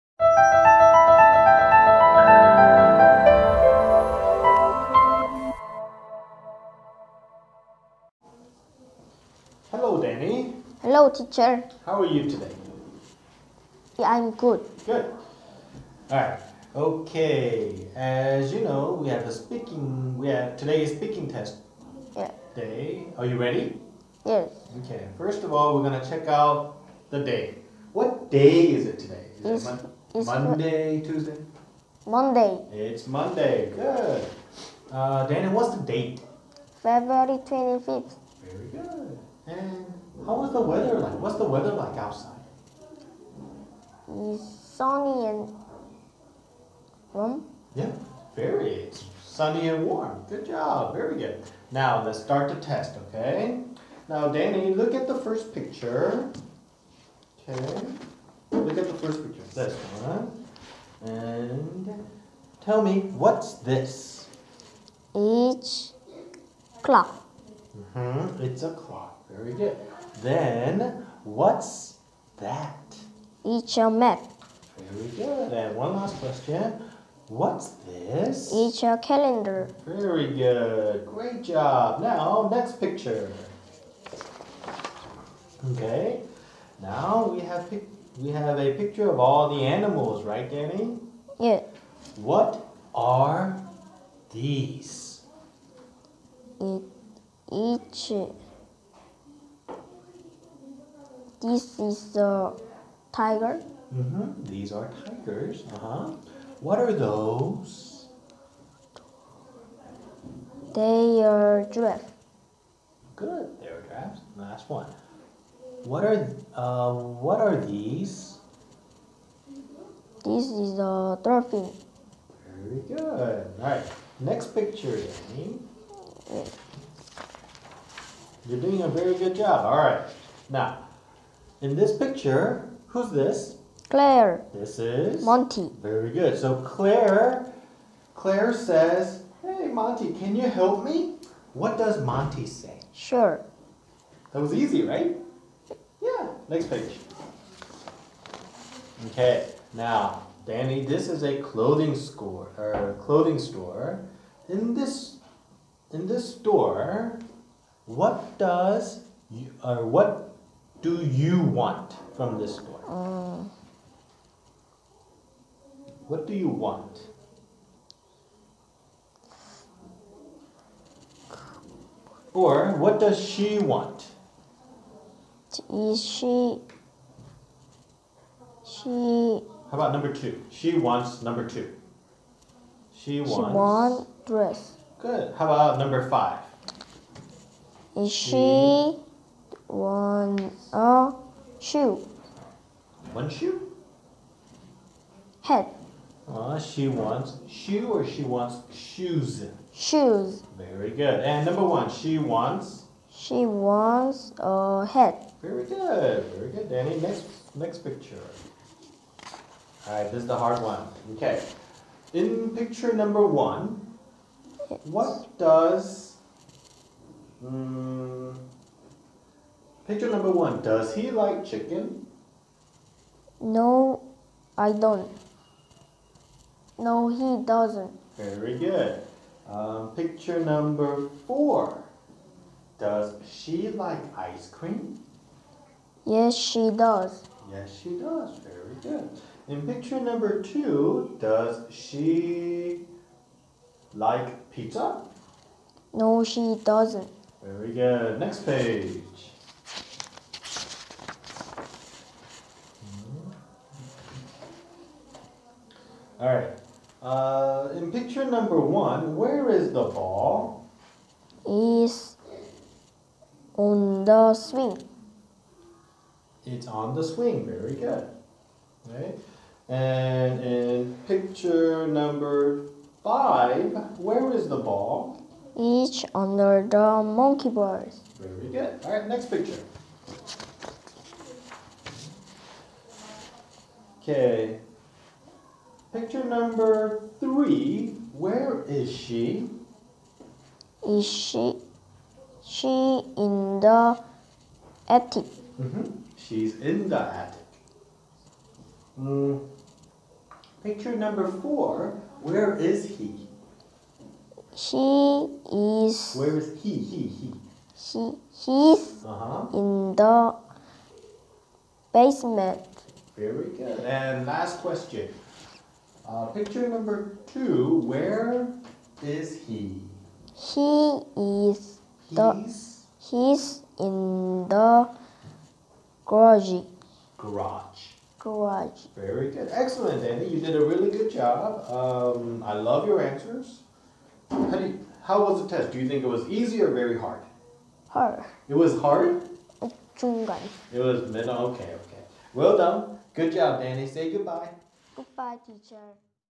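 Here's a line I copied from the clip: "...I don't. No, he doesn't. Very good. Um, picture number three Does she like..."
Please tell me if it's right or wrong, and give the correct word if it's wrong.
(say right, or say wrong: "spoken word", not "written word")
wrong: "four", not "three".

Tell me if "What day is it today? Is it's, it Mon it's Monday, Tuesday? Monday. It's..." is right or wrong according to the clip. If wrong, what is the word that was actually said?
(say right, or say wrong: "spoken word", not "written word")
right.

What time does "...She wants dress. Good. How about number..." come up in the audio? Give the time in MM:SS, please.
03:03.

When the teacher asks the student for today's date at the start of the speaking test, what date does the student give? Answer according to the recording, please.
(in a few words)
February 25.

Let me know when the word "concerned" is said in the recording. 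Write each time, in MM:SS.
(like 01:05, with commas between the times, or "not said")
not said.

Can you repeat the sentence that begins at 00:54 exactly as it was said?
Now, Danny, look at the first picture.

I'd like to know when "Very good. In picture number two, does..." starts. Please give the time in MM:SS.
03:58.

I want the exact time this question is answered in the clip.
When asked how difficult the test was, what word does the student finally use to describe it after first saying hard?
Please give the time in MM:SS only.
05:41.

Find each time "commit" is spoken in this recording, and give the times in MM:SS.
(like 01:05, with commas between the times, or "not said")
not said.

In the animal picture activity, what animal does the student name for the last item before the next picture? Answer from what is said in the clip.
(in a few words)
dolphin.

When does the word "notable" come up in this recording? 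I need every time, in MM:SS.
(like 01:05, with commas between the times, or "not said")
not said.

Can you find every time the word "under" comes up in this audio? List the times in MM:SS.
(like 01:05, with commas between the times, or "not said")
04:36.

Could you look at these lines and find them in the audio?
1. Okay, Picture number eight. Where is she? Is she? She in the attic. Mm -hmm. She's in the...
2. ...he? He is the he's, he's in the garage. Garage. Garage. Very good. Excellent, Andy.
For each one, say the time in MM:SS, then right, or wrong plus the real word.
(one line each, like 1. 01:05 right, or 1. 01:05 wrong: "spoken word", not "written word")
1. 04:44 wrong: "three", not "eight"
2. 05:19 right.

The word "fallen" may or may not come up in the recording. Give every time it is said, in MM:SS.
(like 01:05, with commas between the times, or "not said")
not said.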